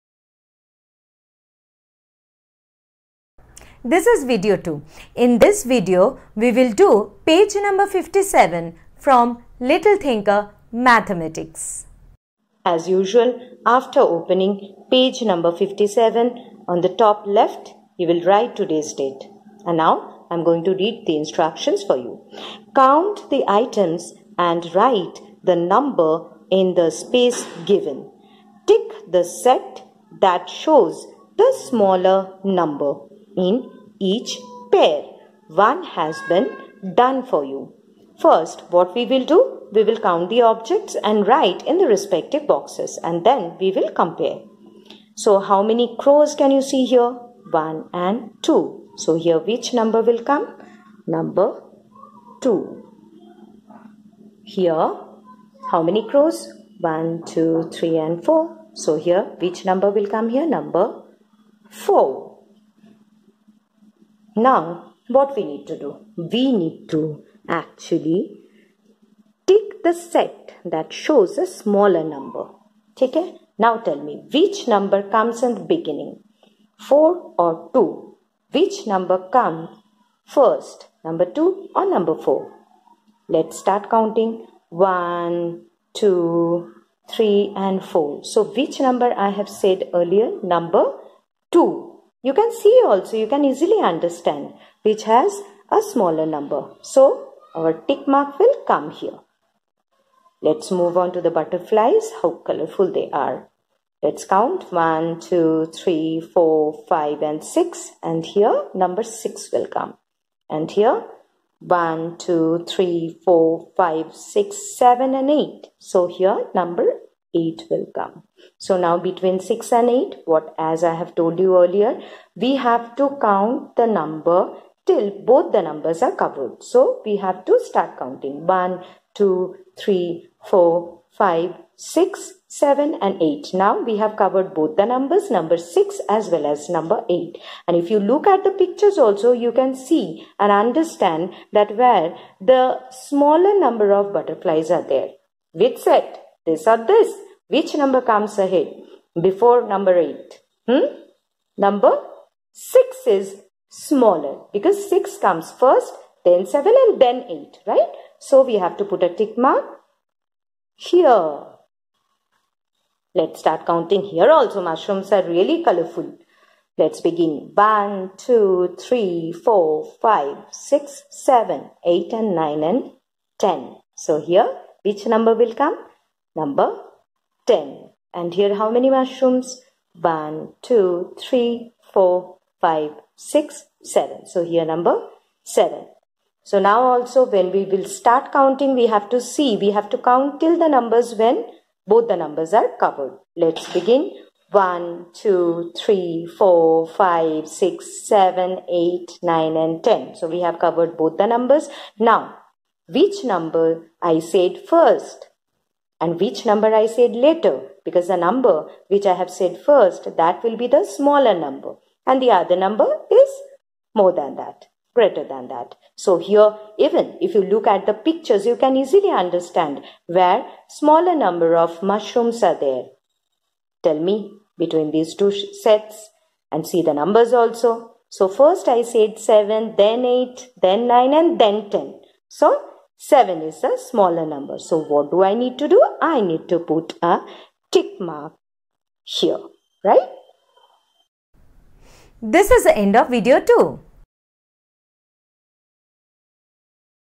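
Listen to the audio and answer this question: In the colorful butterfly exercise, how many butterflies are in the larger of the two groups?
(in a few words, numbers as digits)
8.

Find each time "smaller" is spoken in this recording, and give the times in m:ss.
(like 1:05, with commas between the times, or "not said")
0:31, 1:11, 1:35, 2:22, 2:33, 3:30, 3:40, 3:53.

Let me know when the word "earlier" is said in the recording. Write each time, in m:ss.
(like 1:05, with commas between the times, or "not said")
1:29, 2:01.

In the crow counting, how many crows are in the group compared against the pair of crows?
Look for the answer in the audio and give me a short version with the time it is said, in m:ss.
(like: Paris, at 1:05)
4, at 0:58.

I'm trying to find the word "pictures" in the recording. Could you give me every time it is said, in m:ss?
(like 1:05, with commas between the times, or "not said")
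2:18, 3:37.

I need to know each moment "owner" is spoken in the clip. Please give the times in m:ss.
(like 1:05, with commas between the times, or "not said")
not said.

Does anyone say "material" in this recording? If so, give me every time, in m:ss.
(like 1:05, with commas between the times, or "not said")
not said.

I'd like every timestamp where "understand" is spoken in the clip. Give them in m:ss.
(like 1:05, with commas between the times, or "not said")
1:33, 2:20, 3:39.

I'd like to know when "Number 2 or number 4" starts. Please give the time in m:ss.
1:21.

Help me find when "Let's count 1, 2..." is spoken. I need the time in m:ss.
1:44.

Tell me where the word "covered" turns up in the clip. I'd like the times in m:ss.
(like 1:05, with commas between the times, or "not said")
2:06, 2:14, 3:12, 3:20.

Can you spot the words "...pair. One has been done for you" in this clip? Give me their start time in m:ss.
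0:34.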